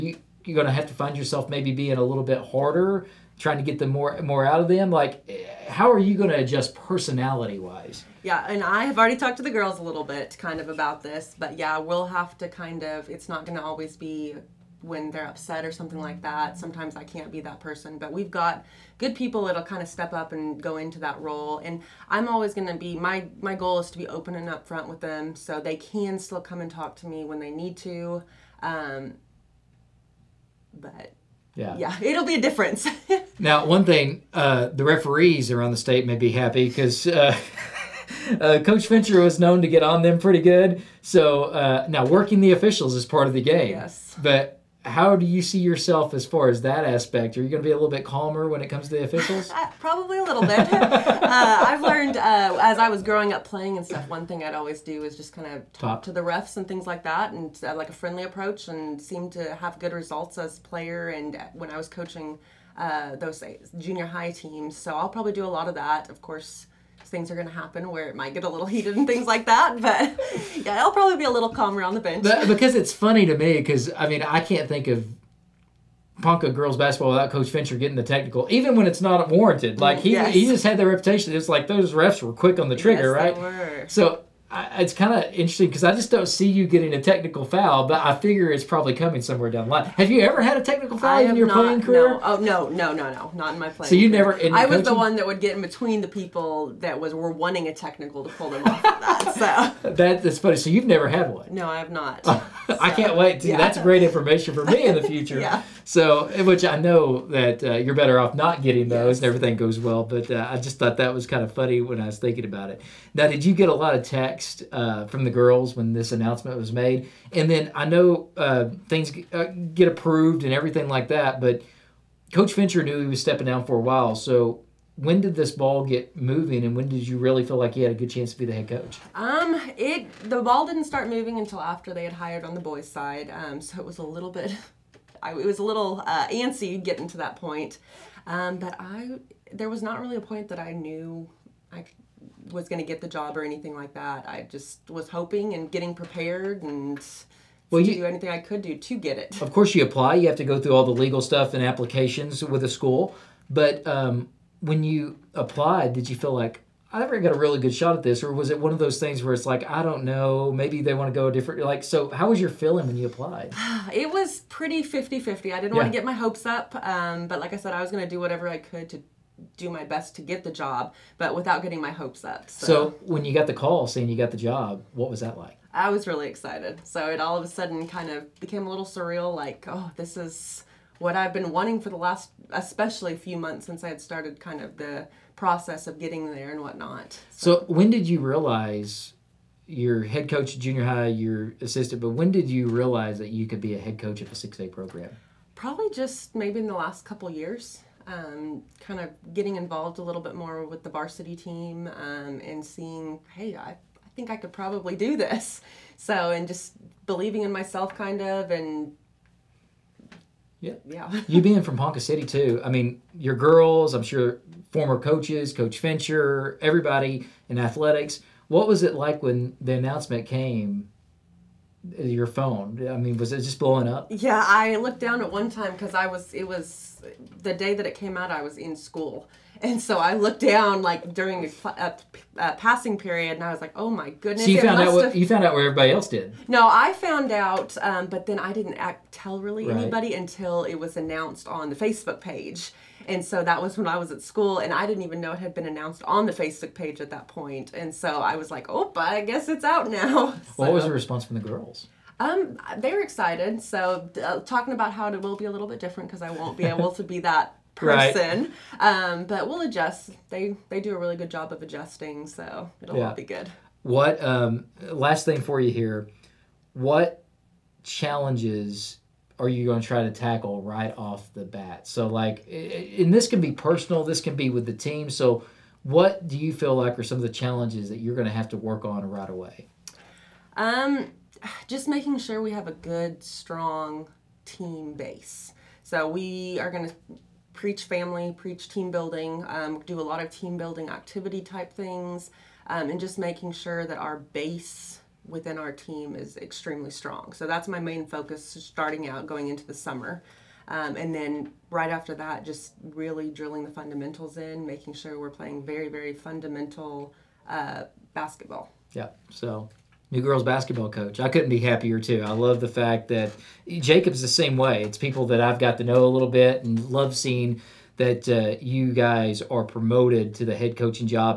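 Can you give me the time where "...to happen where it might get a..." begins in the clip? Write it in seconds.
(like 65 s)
67 s.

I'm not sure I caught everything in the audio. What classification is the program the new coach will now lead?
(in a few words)
6A.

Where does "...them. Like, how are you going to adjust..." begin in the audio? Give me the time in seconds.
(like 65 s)
4 s.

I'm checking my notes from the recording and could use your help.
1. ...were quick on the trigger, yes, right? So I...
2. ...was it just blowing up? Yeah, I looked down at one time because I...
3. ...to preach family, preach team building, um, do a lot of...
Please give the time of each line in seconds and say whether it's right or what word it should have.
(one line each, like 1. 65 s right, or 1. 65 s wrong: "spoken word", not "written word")
1. 82 s right
2. 223 s right
3. 286 s right.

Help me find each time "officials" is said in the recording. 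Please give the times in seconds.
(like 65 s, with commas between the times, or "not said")
42 s, 49 s.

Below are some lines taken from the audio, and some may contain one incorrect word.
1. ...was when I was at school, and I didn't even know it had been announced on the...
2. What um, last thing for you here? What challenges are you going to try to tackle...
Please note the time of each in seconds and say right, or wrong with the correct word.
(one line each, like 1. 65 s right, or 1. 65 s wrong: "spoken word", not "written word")
1. 243 s right
2. 263 s right.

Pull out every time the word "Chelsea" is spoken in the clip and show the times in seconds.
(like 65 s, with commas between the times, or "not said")
not said.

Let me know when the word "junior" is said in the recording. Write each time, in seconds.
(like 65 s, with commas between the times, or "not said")
63 s, 190 s.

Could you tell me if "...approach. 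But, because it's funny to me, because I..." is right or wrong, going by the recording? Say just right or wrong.
wrong.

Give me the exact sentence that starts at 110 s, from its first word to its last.
But uh, I just thought that was kind of funny when I was thinking about it.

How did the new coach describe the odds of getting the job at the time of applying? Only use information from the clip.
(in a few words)
50-50.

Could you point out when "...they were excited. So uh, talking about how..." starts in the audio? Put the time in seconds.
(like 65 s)
252 s.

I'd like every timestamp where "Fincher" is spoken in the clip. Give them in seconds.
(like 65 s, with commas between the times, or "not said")
38 s, 77 s, 122 s, 215 s.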